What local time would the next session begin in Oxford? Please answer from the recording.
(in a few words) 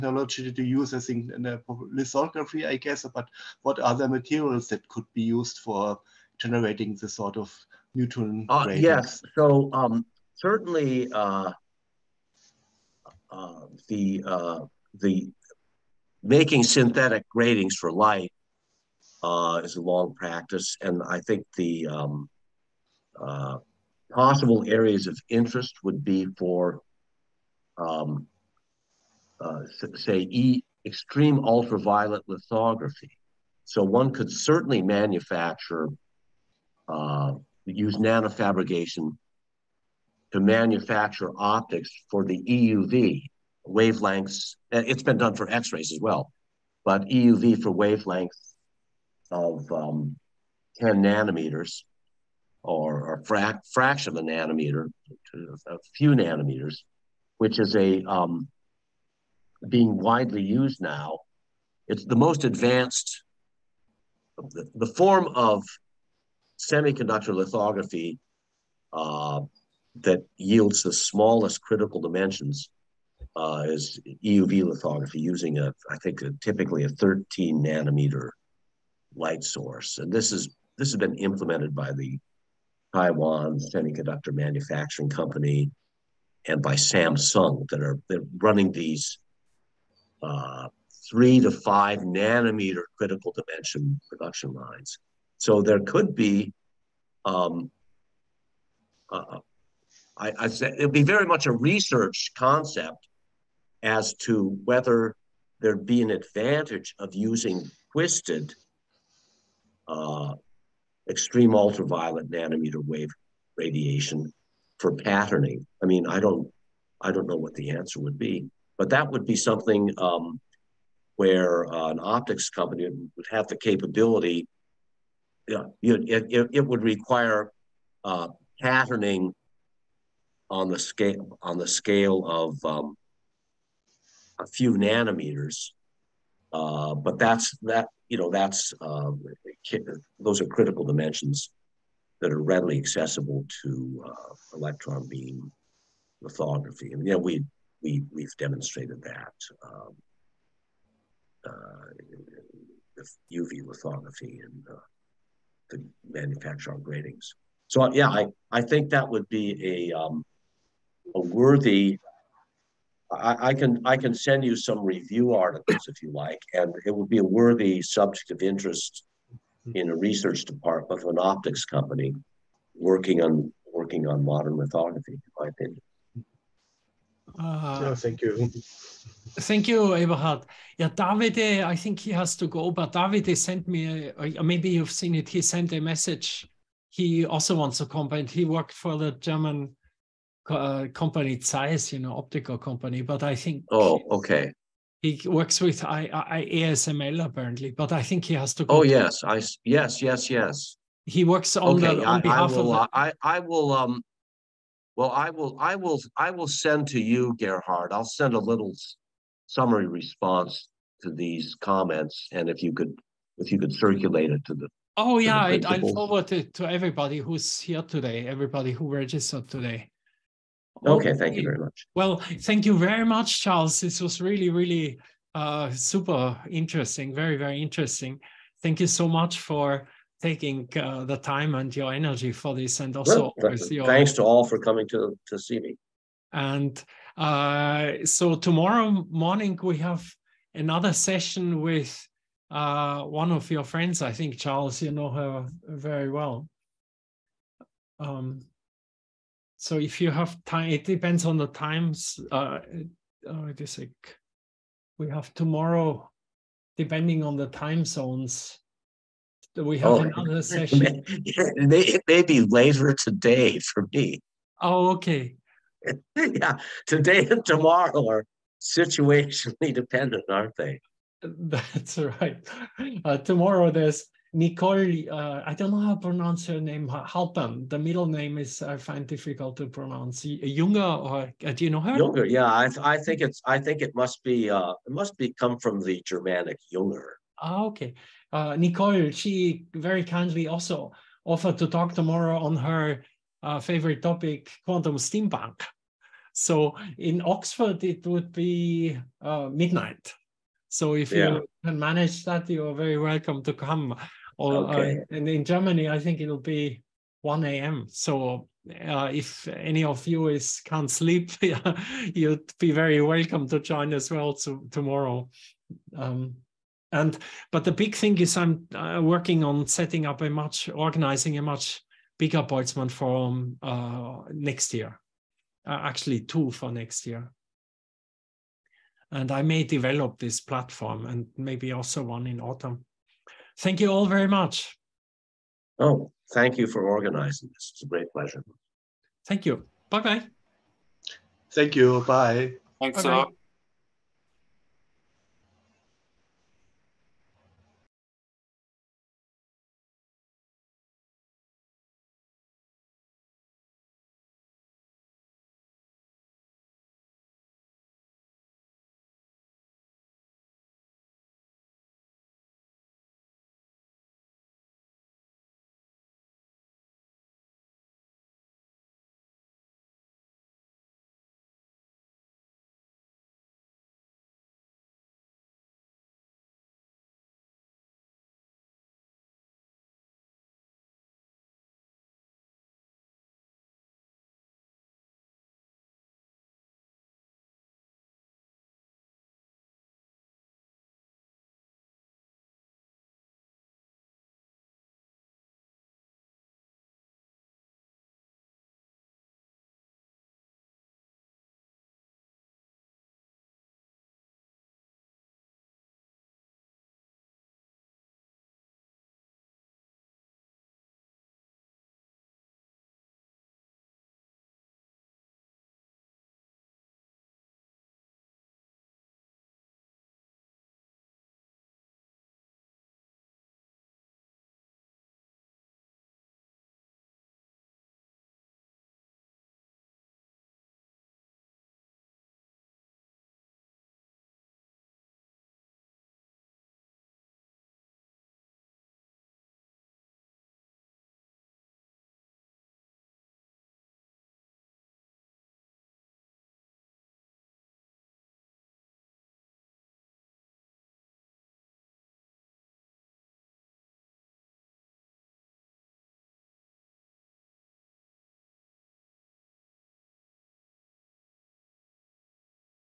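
Midnight.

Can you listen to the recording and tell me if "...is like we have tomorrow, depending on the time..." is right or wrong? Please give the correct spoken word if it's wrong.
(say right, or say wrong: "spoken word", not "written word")
right.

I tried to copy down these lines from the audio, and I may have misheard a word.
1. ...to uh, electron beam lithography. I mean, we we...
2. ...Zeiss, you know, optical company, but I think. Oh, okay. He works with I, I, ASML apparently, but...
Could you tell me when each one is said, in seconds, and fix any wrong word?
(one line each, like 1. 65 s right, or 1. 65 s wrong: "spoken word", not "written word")
1. 143 s right
2. 191 s right.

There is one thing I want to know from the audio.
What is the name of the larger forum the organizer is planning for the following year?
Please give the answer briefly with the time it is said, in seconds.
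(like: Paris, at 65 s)
Boltzmann forum, at 322 s.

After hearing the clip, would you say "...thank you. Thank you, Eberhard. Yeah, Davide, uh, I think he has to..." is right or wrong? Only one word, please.
right.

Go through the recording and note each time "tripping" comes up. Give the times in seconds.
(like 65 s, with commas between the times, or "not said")
not said.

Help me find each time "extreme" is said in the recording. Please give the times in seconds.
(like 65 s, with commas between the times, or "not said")
30 s, 111 s.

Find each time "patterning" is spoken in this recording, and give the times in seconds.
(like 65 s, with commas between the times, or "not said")
114 s, 128 s.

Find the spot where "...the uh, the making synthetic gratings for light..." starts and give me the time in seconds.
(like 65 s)
13 s.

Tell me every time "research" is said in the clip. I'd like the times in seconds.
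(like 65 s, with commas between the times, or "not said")
101 s, 169 s.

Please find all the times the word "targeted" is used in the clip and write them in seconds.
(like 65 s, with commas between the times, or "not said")
not said.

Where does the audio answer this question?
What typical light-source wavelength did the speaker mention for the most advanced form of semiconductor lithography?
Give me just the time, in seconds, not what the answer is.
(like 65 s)
76 s.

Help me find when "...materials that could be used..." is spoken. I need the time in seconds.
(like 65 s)
4 s.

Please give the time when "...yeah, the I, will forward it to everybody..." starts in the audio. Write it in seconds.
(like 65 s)
215 s.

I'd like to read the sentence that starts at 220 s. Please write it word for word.
Okay, okay, thank you very much.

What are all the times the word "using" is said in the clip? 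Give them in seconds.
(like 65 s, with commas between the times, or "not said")
75 s, 107 s.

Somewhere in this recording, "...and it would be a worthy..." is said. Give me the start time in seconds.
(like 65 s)
166 s.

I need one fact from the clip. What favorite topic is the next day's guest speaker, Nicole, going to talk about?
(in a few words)
Quantum steampunk.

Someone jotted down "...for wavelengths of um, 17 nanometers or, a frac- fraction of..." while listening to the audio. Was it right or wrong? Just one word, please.
wrong.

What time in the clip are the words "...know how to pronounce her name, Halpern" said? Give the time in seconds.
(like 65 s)
275 s.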